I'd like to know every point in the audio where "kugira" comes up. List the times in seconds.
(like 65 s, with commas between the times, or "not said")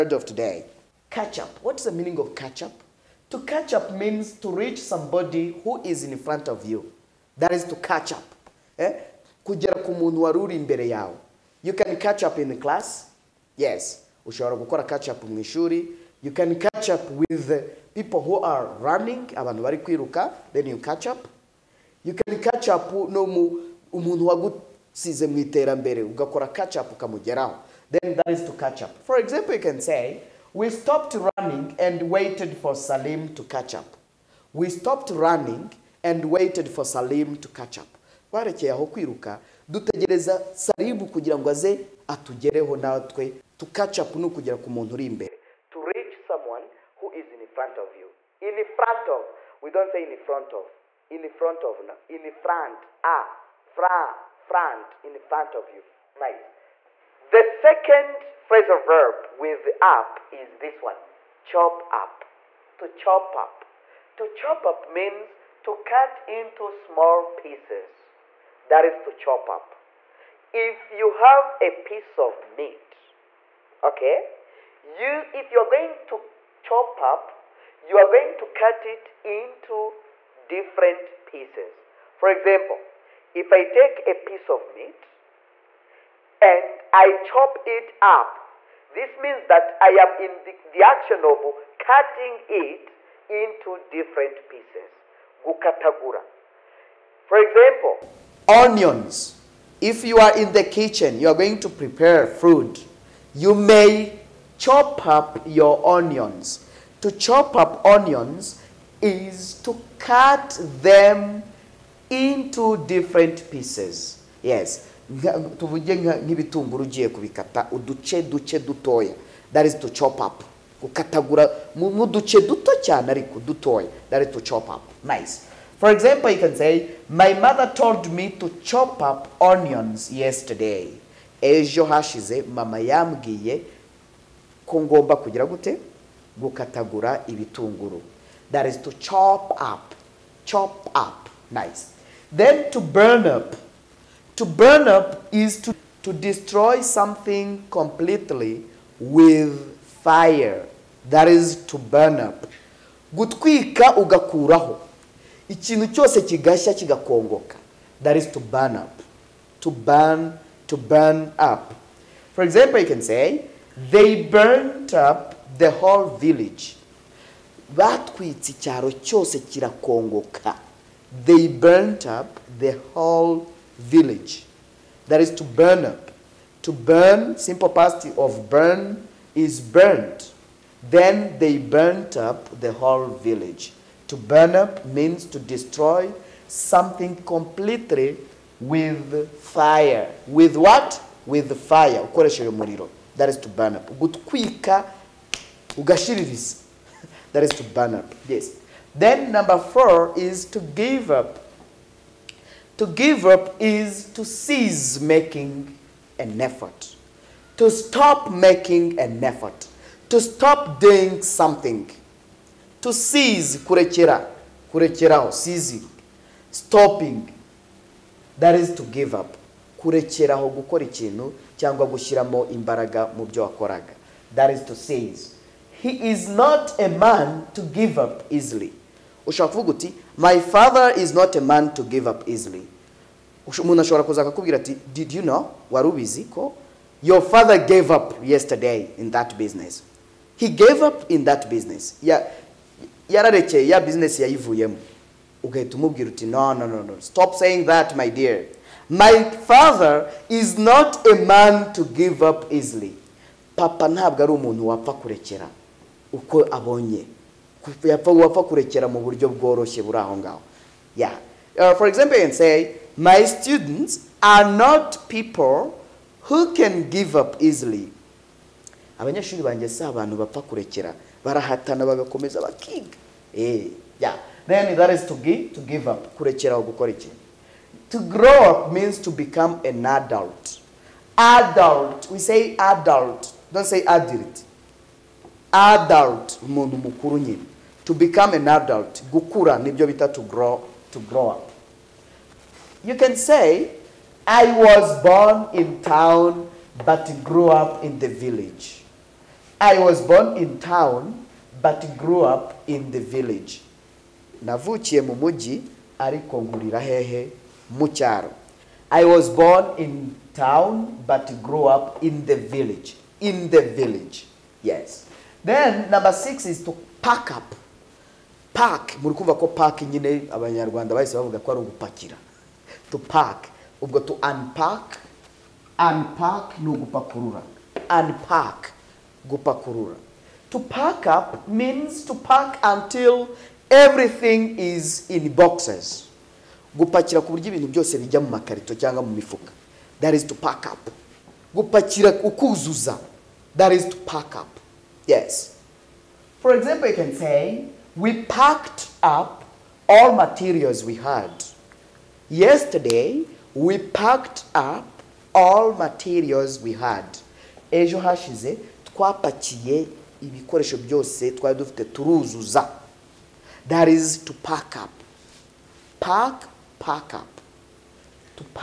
41 s, 135 s.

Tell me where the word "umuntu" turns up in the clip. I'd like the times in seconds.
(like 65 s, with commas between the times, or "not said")
23 s, 233 s, 254 s, 286 s.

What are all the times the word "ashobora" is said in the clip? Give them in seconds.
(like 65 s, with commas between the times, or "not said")
233 s.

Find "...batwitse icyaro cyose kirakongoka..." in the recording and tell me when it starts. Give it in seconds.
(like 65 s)
167 s.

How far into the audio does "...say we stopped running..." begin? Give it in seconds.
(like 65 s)
29 s.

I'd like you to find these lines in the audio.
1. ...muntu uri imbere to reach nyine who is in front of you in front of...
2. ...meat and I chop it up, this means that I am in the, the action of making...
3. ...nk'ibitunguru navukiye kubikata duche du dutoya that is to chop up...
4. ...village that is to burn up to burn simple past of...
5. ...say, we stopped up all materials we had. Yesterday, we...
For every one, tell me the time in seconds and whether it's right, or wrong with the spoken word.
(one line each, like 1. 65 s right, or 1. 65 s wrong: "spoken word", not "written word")
1. 44 s wrong: "someone", not "nyine"
2. 84 s wrong: "cutting", not "making"
3. 115 s wrong: "ugiye", not "navukiye"
4. 173 s right
5. 347 s wrong: "packed", not "stopped".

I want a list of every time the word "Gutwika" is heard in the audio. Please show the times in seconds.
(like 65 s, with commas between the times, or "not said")
153 s, 193 s.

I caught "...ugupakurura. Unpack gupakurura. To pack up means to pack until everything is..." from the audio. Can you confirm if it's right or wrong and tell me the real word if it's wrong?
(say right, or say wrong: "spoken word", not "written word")
right.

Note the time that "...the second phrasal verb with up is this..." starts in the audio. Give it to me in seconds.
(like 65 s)
57 s.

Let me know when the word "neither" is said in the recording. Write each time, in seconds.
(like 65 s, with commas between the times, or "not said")
not said.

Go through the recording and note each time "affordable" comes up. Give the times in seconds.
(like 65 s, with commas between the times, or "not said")
not said.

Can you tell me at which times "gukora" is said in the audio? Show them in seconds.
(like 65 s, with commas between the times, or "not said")
14 s, 220 s, 276 s.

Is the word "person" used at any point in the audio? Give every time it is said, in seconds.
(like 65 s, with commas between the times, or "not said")
not said.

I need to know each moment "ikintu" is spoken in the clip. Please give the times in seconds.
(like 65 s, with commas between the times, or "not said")
155 s, 220 s.